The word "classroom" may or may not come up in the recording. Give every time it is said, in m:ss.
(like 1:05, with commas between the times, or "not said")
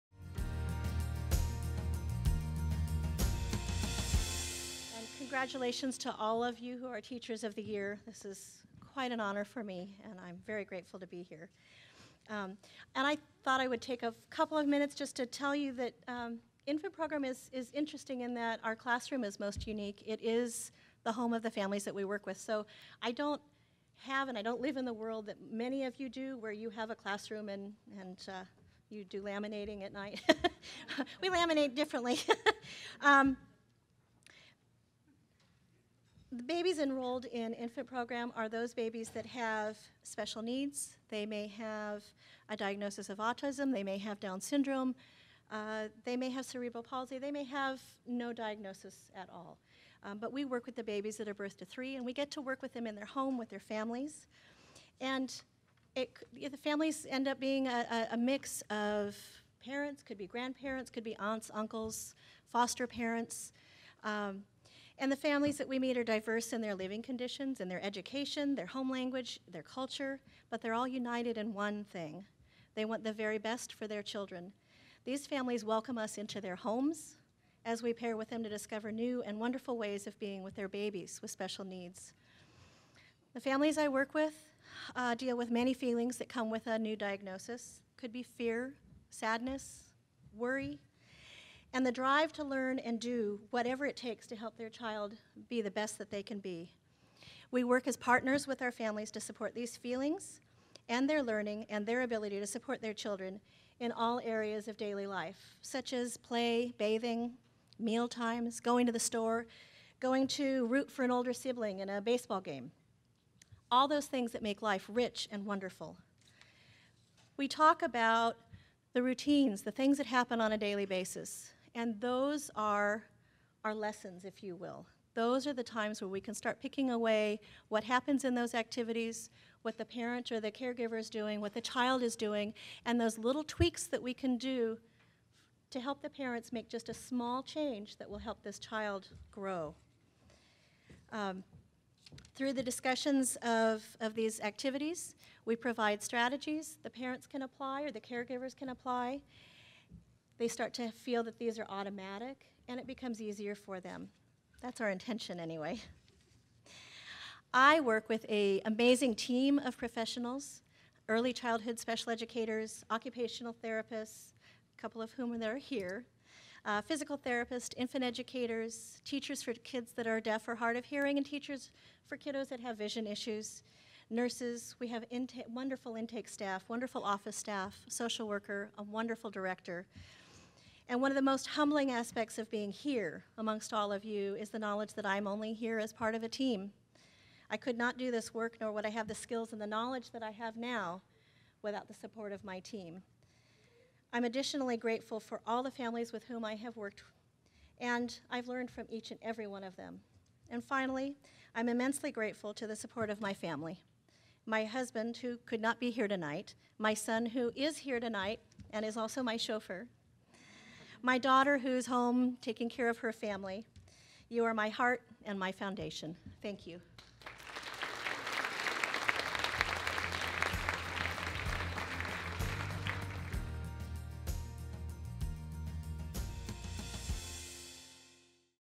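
0:18, 0:26.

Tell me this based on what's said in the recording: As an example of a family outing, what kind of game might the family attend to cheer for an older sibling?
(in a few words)
Baseball game.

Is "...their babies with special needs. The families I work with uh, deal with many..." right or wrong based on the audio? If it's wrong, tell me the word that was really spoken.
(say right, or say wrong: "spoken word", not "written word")
right.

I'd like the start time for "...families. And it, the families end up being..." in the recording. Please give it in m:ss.
0:53.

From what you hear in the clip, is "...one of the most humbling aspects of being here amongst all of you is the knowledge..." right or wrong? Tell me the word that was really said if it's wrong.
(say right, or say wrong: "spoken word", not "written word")
right.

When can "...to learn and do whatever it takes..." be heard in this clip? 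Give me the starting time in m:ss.
1:32.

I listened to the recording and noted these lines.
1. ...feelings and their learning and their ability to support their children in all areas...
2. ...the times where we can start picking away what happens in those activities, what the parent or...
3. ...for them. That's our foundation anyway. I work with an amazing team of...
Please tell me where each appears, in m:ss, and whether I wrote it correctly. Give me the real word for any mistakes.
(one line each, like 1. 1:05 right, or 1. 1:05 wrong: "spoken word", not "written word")
1. 1:39 right
2. 2:05 right
3. 2:33 wrong: "intention", not "foundation".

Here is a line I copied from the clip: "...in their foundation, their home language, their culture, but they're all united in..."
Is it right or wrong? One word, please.
wrong.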